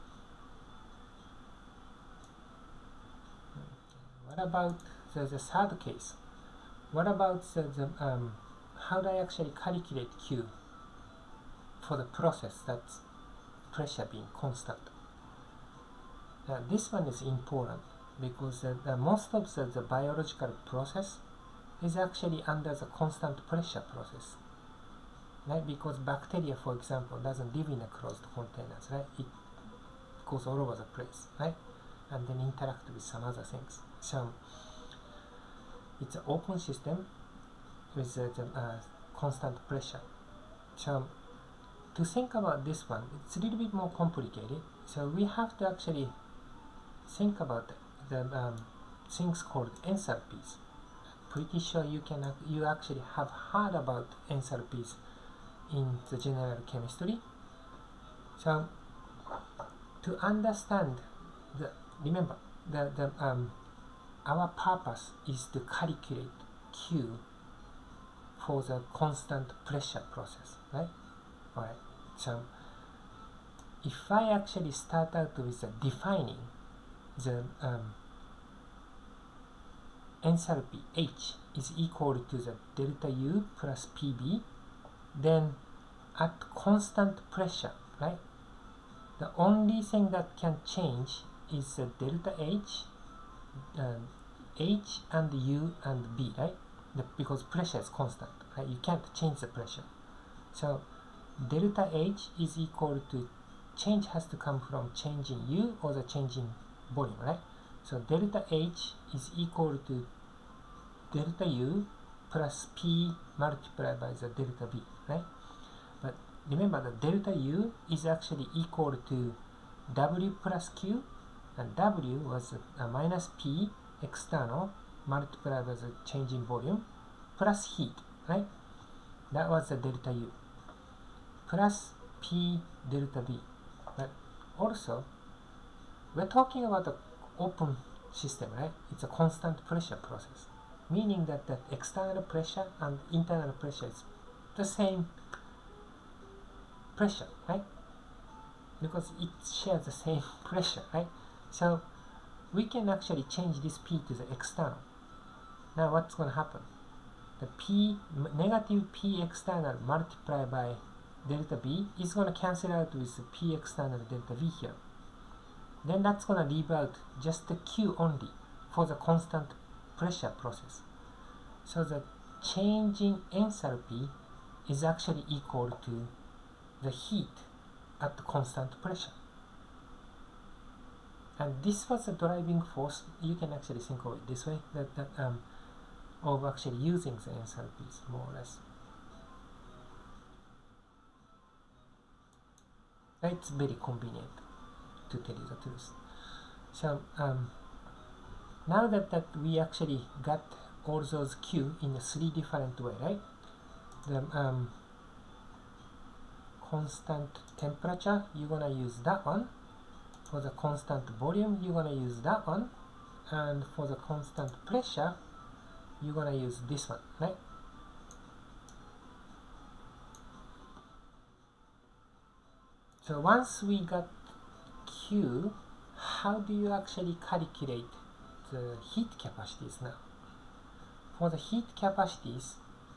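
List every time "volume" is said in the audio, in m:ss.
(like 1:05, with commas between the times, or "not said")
1:46, 2:06, 3:31.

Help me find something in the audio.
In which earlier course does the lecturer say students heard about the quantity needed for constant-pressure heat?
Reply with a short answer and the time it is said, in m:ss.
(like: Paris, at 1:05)
General chemistry, at 0:56.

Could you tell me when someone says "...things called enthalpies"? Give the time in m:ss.
0:49.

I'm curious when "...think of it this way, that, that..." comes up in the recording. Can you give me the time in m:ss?
3:03.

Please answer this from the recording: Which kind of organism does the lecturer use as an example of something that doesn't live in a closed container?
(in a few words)
Bacteria.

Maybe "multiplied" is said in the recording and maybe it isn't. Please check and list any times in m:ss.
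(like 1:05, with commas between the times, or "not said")
1:53, 2:05, 2:39.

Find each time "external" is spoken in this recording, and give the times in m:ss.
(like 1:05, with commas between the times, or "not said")
2:04, 2:21, 2:34, 2:39, 2:43.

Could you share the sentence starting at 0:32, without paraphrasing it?
And then interact with some other things.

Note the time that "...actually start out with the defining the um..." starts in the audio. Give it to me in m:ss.
1:14.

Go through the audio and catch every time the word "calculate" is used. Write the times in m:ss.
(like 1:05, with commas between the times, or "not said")
0:09, 1:05, 3:47.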